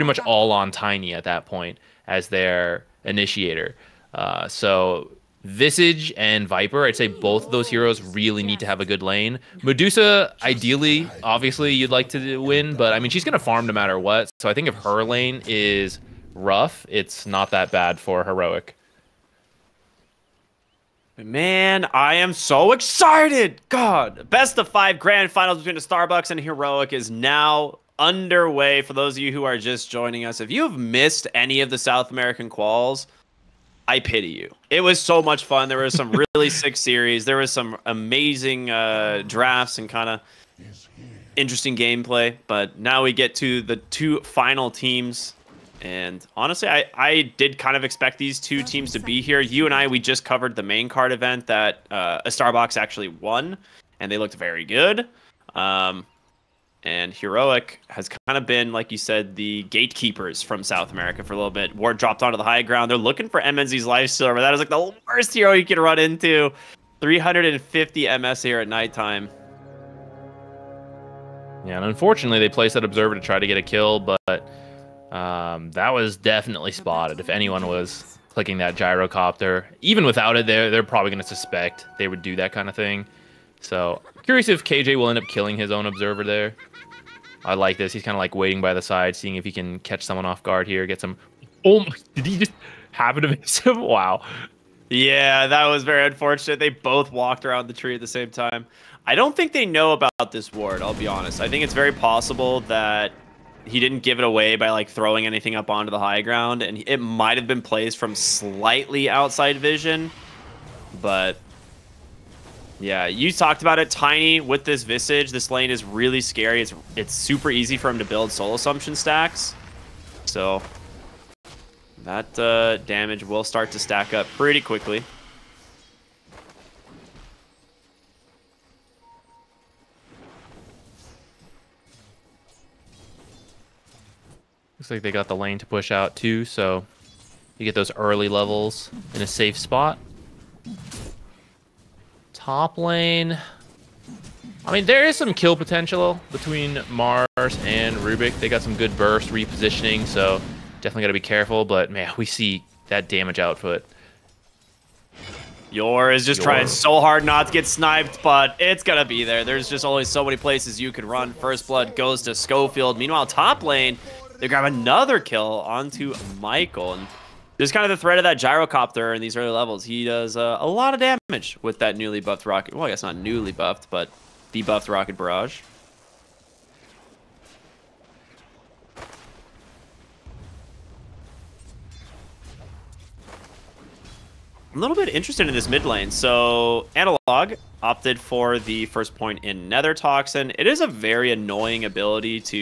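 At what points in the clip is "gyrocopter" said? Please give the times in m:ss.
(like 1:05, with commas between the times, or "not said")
1:18, 2:48.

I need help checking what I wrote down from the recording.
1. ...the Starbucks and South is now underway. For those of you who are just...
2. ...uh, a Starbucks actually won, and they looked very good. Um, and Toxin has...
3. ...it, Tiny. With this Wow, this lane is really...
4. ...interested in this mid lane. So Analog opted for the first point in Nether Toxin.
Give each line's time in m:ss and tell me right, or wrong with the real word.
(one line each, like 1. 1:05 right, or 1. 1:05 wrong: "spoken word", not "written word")
1. 0:25 wrong: "Heroic", not "South"
2. 0:51 wrong: "Heroic", not "Toxin"
3. 1:53 wrong: "Visage", not "Wow"
4. 3:05 right.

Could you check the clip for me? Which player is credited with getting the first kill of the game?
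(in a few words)
Schofield.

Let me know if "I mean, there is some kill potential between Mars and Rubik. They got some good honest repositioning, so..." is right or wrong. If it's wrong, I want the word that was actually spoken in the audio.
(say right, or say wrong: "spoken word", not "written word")
wrong: "burst", not "honest".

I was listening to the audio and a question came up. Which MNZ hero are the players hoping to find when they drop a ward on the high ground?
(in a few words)
Lifestealer.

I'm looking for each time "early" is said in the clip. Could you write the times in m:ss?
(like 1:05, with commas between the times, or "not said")
2:17, 2:49.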